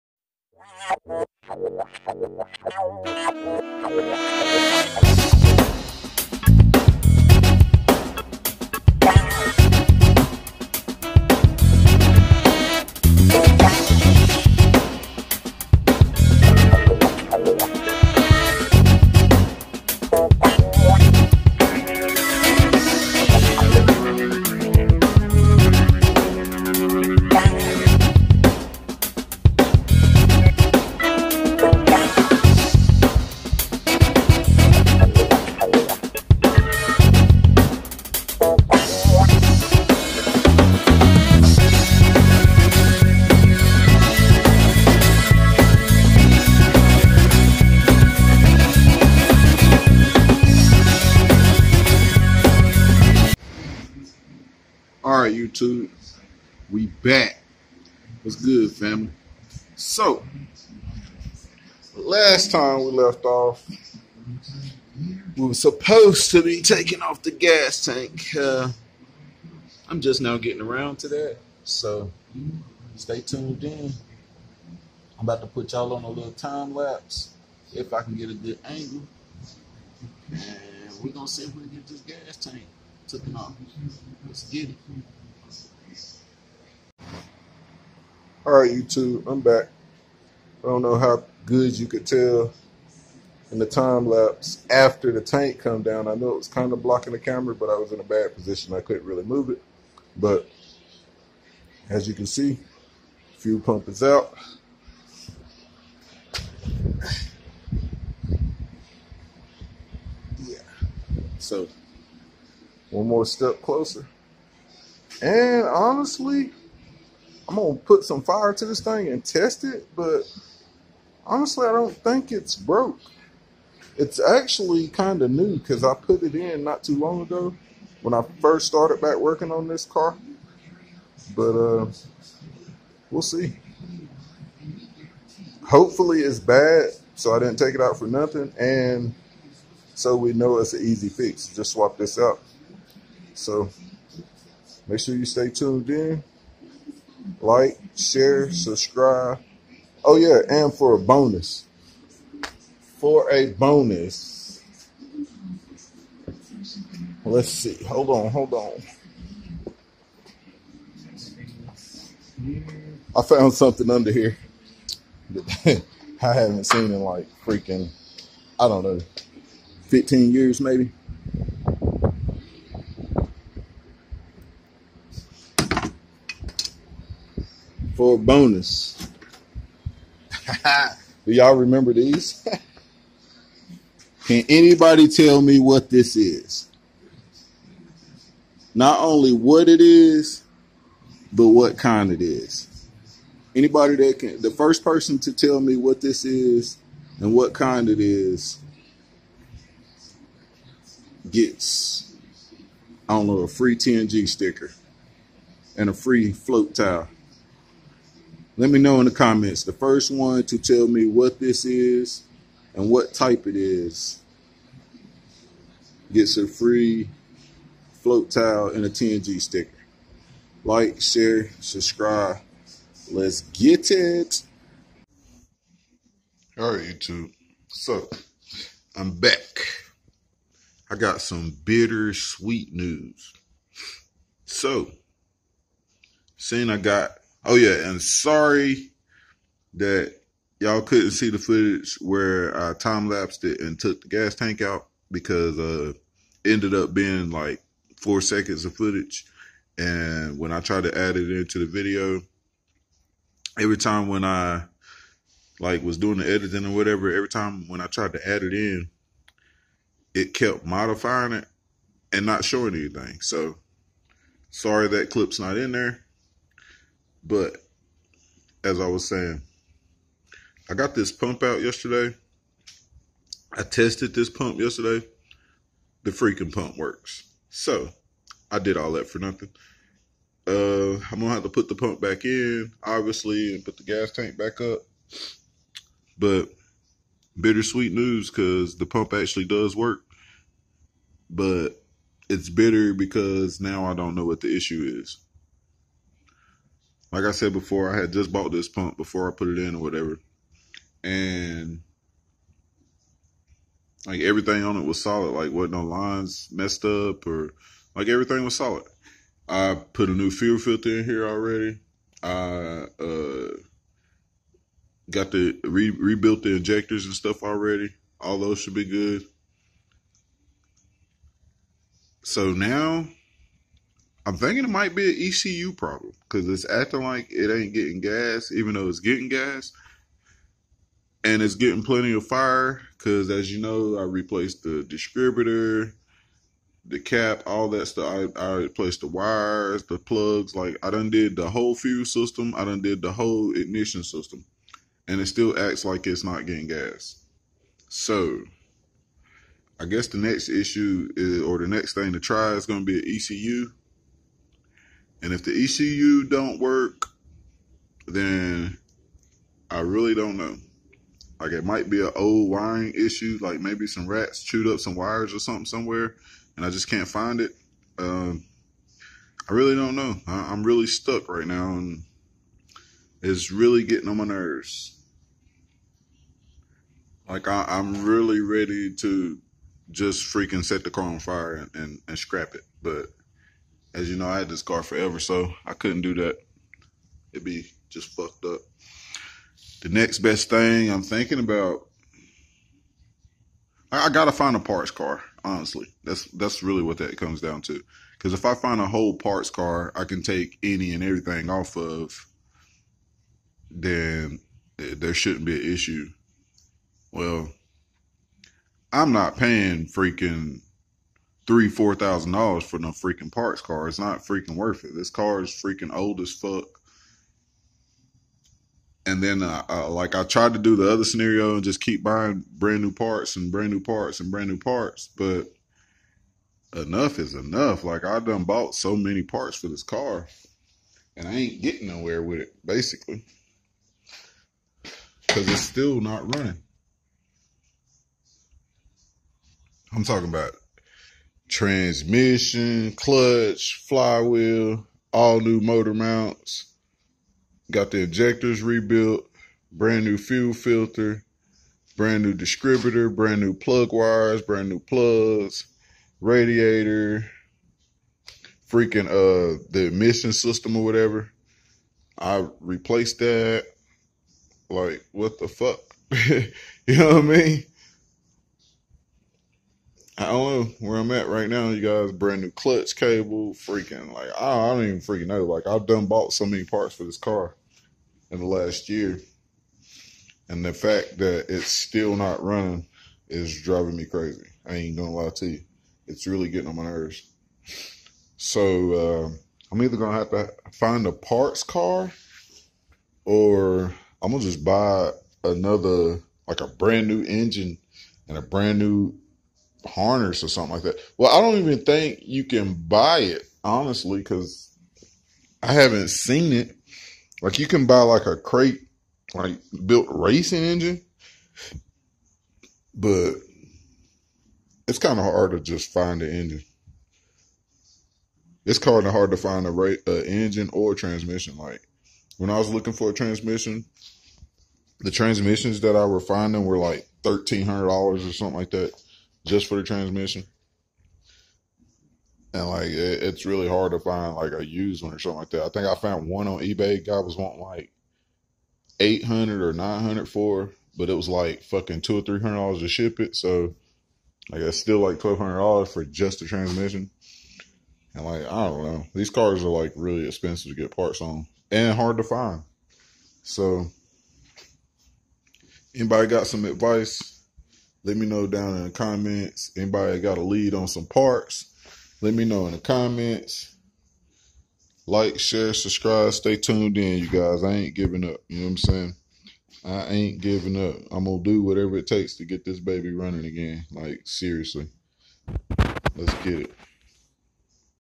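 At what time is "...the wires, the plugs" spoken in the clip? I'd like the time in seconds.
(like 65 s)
339 s.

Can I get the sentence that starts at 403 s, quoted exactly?
Then there shouldn't be an issue.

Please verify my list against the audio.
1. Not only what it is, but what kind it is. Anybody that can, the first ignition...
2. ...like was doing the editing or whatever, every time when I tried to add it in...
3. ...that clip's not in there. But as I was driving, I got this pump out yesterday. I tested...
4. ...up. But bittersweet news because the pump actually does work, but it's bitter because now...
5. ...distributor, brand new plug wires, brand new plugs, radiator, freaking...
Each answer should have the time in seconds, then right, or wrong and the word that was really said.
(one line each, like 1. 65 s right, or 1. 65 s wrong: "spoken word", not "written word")
1. 188 s wrong: "person", not "ignition"
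2. 255 s right
3. 264 s wrong: "saying", not "driving"
4. 284 s right
5. 452 s right.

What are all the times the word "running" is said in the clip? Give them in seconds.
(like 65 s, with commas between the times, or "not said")
436 s, 482 s, 573 s.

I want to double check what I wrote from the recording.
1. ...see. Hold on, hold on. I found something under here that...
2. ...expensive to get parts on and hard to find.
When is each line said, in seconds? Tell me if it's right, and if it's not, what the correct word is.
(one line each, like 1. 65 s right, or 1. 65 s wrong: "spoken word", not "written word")
1. 157 s right
2. 550 s right.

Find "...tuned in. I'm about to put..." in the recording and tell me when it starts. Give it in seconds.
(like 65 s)
73 s.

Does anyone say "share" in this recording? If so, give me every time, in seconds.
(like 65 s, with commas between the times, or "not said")
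147 s, 221 s, 565 s.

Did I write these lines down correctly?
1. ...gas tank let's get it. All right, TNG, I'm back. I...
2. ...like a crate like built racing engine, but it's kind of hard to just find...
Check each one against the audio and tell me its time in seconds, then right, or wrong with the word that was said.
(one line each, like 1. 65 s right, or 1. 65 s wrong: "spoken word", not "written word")
1. 82 s wrong: "YouTube", not "TNG"
2. 508 s right.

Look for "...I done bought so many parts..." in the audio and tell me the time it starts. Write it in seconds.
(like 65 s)
428 s.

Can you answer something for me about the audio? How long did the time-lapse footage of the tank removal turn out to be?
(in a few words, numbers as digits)
4 seconds.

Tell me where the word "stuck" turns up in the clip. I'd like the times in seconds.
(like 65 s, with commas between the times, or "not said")
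370 s.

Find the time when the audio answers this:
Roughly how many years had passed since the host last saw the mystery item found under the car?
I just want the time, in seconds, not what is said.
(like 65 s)
169 s.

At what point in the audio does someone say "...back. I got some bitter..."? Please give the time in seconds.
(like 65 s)
229 s.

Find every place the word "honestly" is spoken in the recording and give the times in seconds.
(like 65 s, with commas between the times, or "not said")
115 s, 121 s, 395 s, 503 s.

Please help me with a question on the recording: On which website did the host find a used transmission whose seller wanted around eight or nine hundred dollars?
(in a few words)
eBay.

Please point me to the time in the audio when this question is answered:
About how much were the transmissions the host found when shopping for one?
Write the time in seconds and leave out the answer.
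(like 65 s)
527 s.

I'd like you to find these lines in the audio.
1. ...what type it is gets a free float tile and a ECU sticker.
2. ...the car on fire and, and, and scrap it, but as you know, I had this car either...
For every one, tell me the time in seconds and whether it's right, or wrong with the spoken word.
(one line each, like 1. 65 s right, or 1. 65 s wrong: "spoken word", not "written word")
1. 212 s wrong: "TNG", not "ECU"
2. 380 s wrong: "forever", not "either".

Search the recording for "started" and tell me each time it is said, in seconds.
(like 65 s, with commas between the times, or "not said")
128 s.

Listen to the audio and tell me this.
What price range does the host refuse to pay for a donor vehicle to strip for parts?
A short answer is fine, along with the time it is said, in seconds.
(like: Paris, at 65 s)
$3,000-4,000, at 411 s.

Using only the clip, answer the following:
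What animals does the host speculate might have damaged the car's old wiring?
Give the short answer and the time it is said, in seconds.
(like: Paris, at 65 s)
rats, at 364 s.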